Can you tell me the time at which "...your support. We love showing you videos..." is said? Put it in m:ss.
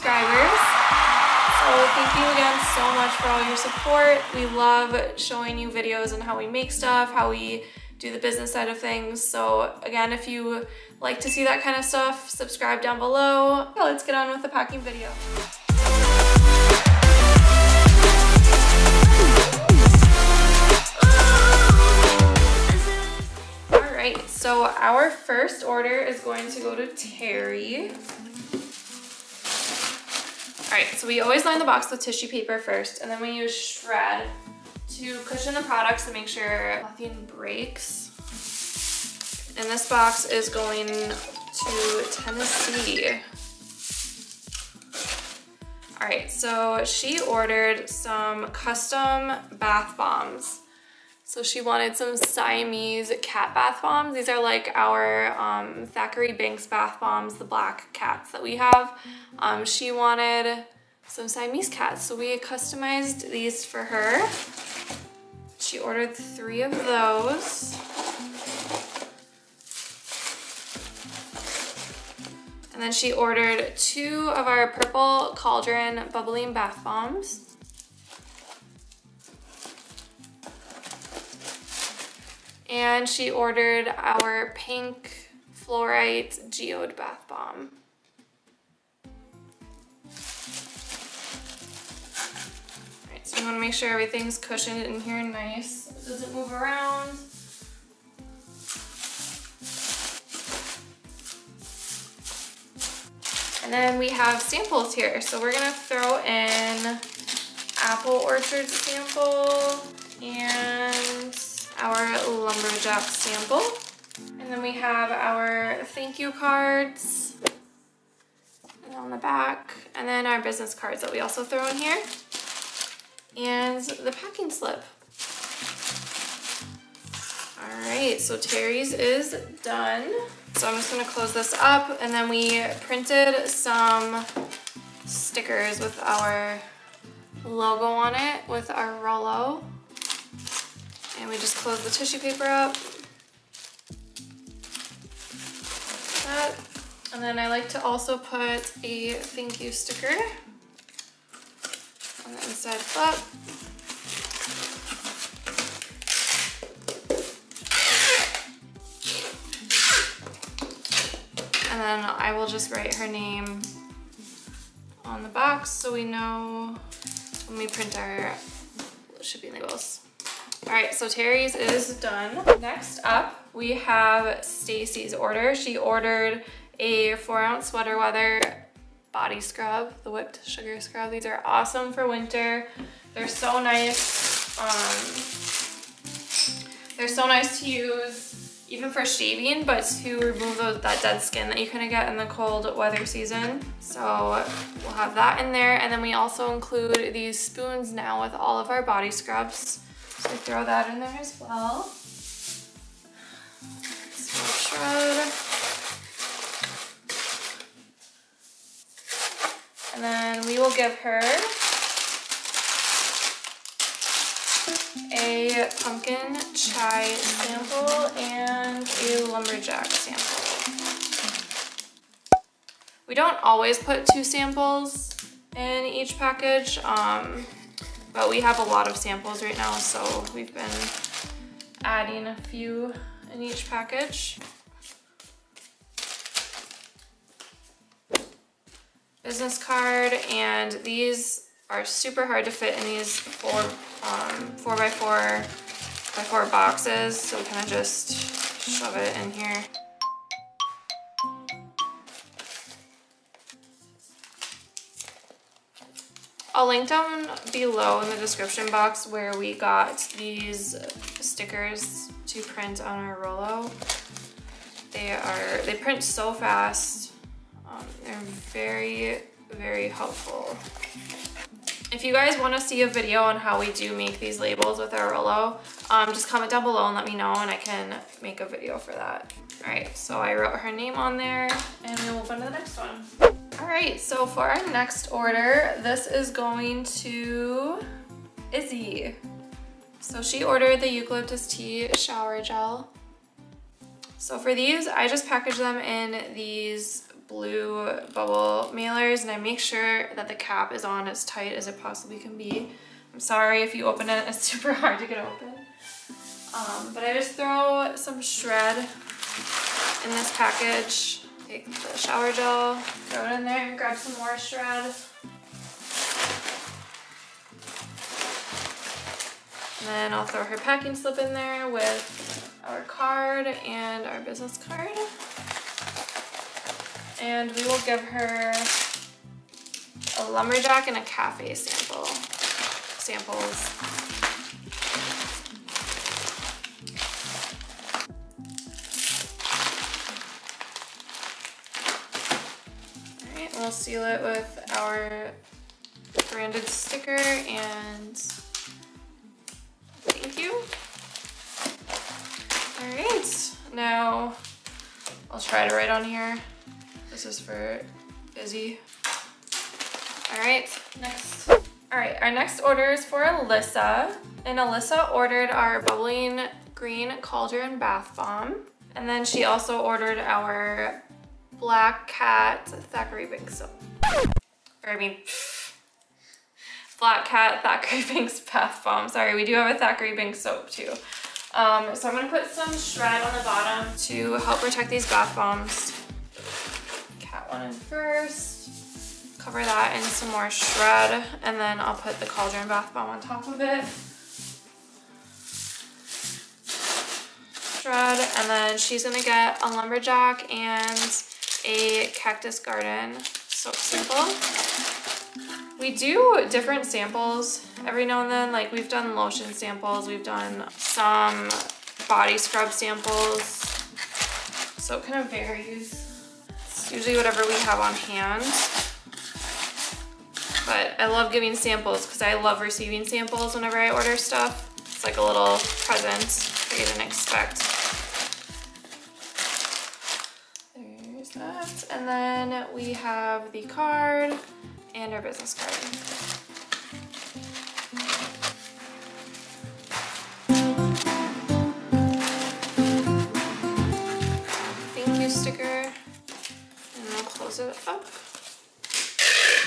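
0:03.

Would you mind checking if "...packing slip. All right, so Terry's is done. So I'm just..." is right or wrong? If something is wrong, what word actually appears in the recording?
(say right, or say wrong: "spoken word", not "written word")
right.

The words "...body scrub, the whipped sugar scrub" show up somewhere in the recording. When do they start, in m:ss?
2:59.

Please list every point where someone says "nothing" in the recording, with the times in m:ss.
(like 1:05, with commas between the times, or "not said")
0:36.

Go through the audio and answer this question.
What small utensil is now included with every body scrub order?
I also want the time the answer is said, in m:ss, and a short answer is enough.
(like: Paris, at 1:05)
Spoons, at 3:17.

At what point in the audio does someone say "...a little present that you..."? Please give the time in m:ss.
7:05.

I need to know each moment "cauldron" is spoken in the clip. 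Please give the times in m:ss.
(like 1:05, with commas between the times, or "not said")
1:15, 6:07, 6:32.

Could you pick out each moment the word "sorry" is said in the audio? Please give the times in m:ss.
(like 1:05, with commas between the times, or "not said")
5:03, 6:19.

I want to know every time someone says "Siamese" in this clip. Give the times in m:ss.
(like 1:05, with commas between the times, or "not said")
0:52, 1:01.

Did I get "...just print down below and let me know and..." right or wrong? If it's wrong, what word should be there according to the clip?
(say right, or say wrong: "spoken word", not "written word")
wrong: "comment", not "print".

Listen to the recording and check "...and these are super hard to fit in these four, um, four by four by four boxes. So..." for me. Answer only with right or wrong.
right.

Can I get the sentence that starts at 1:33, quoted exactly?
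Alright, so you want to make sure everything's cushioned in here nice.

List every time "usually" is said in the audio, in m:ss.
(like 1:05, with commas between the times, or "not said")
6:56.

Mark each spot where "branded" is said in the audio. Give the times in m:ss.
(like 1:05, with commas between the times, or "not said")
5:46.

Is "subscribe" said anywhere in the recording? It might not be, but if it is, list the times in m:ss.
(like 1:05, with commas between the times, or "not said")
0:12.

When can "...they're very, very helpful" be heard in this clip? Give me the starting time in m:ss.
4:28.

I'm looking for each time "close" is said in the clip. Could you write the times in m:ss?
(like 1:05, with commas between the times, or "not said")
2:11, 2:21, 7:27.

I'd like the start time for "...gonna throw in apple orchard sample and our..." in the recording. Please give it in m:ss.
1:45.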